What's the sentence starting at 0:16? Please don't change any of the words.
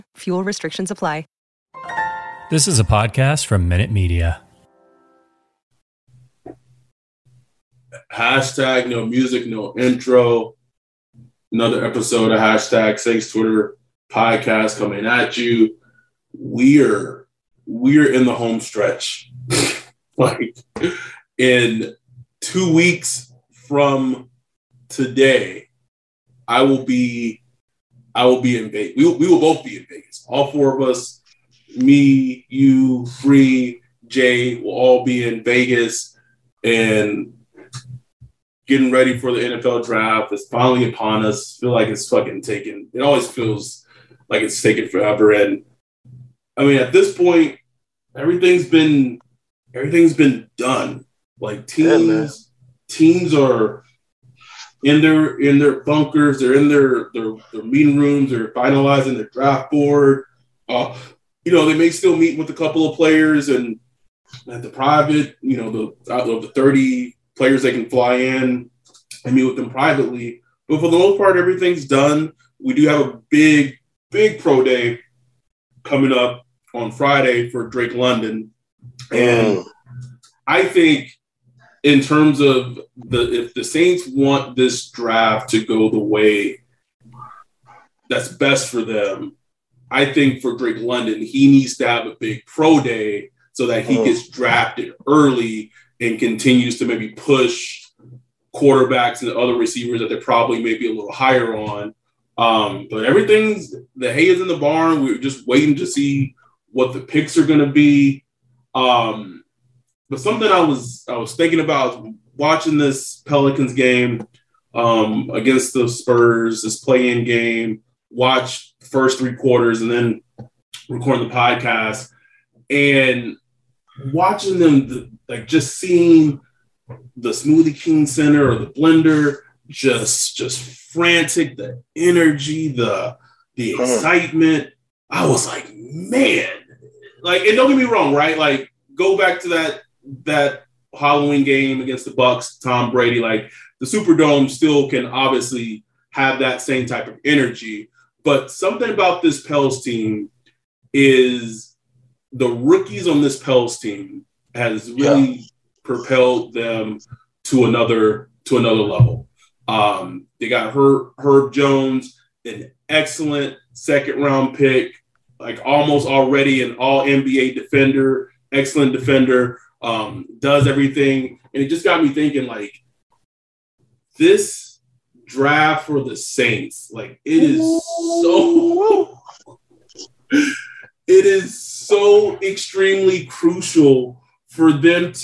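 We're we're in the home stretch.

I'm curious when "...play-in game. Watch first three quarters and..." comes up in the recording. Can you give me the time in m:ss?
1:56.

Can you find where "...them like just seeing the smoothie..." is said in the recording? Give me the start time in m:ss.
2:04.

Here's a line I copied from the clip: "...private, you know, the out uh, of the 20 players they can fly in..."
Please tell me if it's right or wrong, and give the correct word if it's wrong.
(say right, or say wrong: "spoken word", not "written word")
wrong: "30", not "20".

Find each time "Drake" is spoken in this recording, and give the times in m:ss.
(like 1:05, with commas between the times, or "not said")
1:17, 1:30.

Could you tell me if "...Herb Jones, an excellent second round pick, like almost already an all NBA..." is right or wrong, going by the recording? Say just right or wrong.
right.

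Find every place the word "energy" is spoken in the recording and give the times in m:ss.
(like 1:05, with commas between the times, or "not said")
2:11, 2:27.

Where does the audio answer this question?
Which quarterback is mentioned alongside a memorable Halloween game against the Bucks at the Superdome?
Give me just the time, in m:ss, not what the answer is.
2:22.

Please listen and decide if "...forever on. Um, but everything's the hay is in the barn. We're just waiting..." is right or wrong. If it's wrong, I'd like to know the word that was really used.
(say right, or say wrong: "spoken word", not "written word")
wrong: "higher", not "forever".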